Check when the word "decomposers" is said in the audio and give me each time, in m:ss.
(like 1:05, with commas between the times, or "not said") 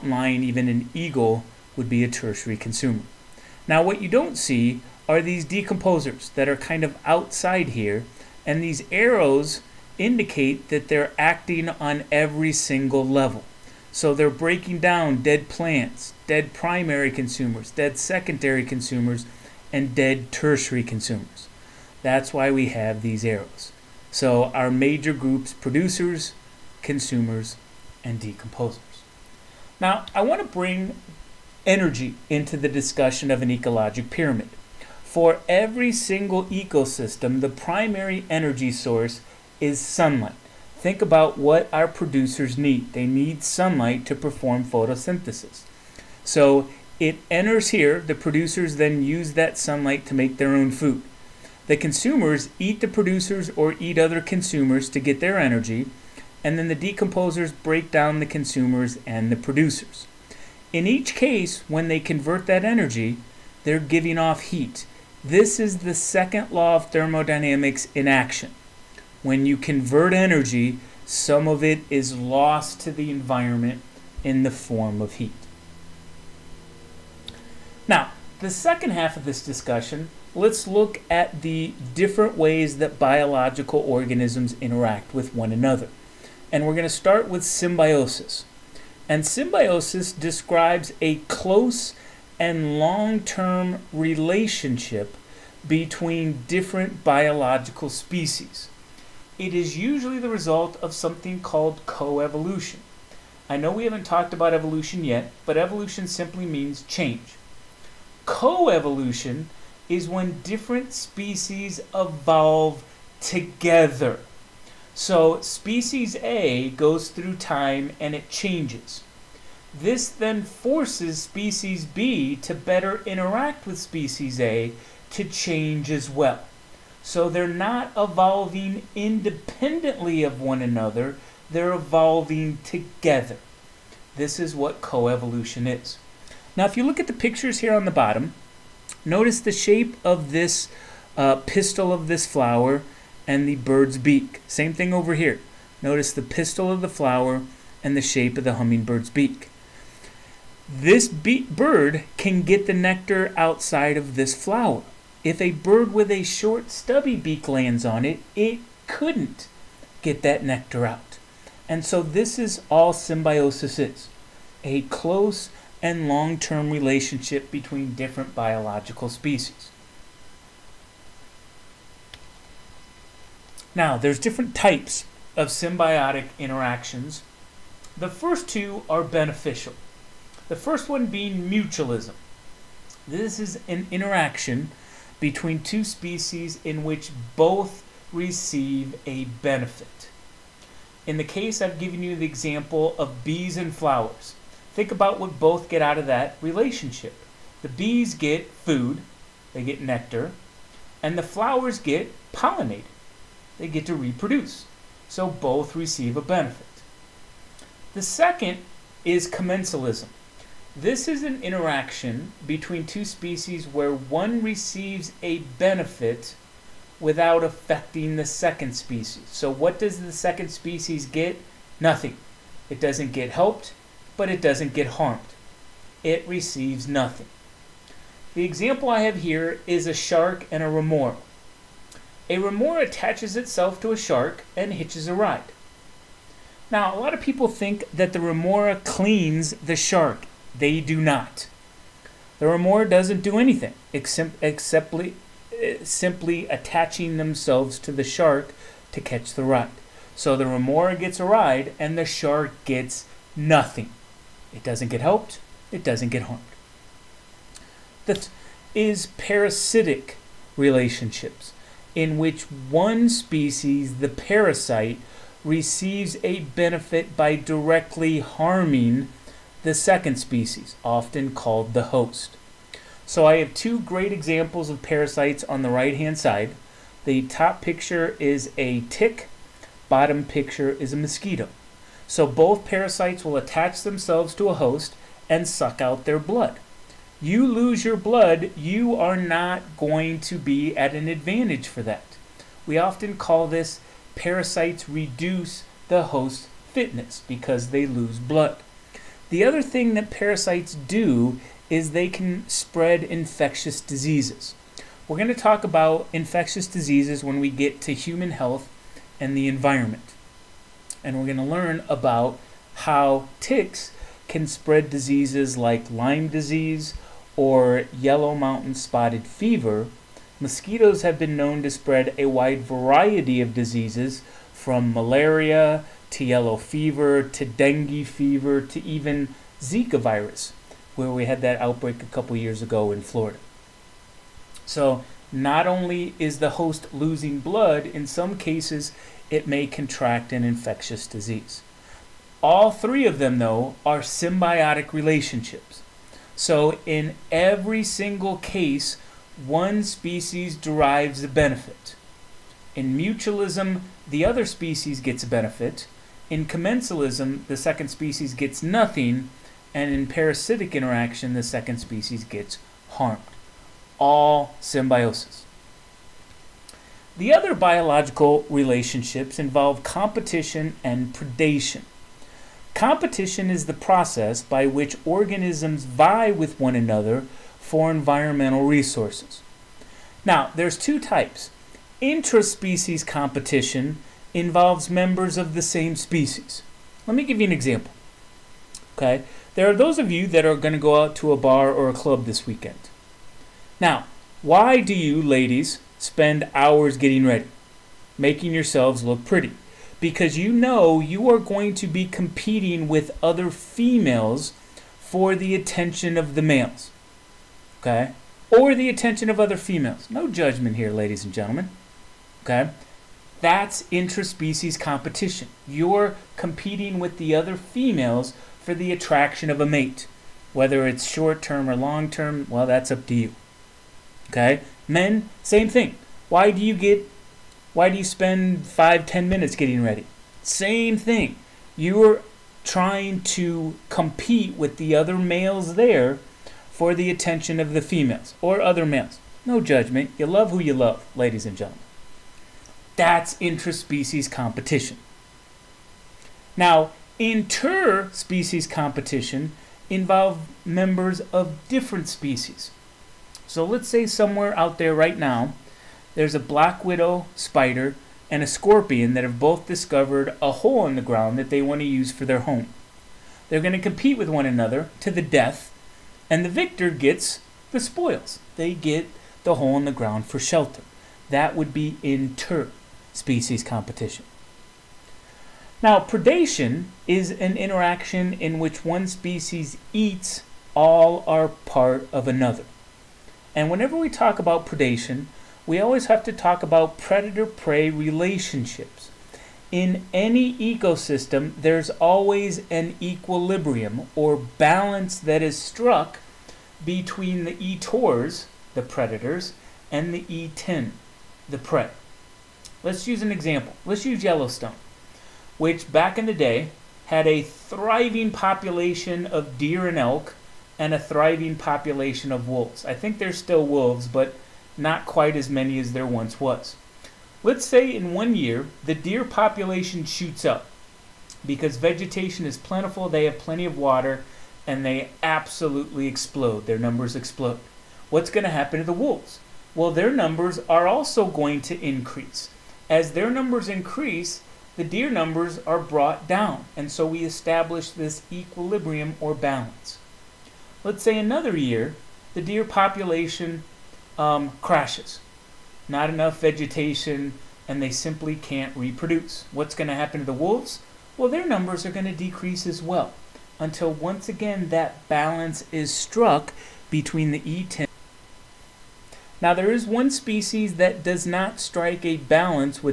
0:05, 0:28, 0:56.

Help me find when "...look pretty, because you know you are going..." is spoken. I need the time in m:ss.
6:39.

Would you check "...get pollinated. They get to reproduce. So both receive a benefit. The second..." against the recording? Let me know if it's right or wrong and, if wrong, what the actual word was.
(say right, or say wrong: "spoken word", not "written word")
right.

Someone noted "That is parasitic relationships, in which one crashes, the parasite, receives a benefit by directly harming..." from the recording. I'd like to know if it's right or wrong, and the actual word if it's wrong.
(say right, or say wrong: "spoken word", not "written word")
wrong: "species", not "crashes".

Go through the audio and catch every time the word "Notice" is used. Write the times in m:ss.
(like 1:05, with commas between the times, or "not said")
2:19, 2:25.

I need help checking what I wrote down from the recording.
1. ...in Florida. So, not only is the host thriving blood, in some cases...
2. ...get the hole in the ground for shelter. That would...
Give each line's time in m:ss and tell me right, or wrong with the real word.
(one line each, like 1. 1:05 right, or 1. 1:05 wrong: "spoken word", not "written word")
1. 5:32 wrong: "losing", not "thriving"
2. 7:48 right.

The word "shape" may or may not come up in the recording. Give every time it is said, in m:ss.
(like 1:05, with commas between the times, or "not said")
2:19, 2:28.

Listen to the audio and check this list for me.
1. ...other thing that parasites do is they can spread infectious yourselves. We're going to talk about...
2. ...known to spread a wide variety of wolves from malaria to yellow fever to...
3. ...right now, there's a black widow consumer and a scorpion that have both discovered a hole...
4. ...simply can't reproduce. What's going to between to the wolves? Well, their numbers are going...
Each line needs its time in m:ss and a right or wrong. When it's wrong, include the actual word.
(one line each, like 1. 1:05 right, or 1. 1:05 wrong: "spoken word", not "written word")
1. 4:59 wrong: "diseases", not "yourselves"
2. 5:21 wrong: "diseases", not "wolves"
3. 7:34 wrong: "spider", not "consumer"
4. 9:07 wrong: "happen", not "between".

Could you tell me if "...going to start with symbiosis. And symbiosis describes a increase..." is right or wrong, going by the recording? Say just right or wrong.
wrong.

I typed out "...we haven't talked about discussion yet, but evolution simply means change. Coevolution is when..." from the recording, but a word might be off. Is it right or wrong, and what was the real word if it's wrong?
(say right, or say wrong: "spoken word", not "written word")
wrong: "evolution", not "discussion".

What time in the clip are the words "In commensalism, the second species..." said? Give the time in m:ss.
5:56.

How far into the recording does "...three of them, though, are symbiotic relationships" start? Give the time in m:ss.
5:42.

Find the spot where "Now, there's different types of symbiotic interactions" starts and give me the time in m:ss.
2:53.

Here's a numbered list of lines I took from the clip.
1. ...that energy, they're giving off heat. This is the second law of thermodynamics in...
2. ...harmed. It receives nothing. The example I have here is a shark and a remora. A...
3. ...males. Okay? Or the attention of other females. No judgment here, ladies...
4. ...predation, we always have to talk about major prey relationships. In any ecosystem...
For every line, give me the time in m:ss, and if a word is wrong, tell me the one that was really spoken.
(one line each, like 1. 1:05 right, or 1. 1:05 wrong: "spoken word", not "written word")
1. 1:02 right
2. 3:44 right
3. 6:46 right
4. 8:04 wrong: "predator", not "major".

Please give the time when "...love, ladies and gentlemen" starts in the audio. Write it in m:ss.
7:20.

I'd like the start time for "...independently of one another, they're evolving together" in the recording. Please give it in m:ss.
2:08.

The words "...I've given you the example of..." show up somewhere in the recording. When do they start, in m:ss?
3:11.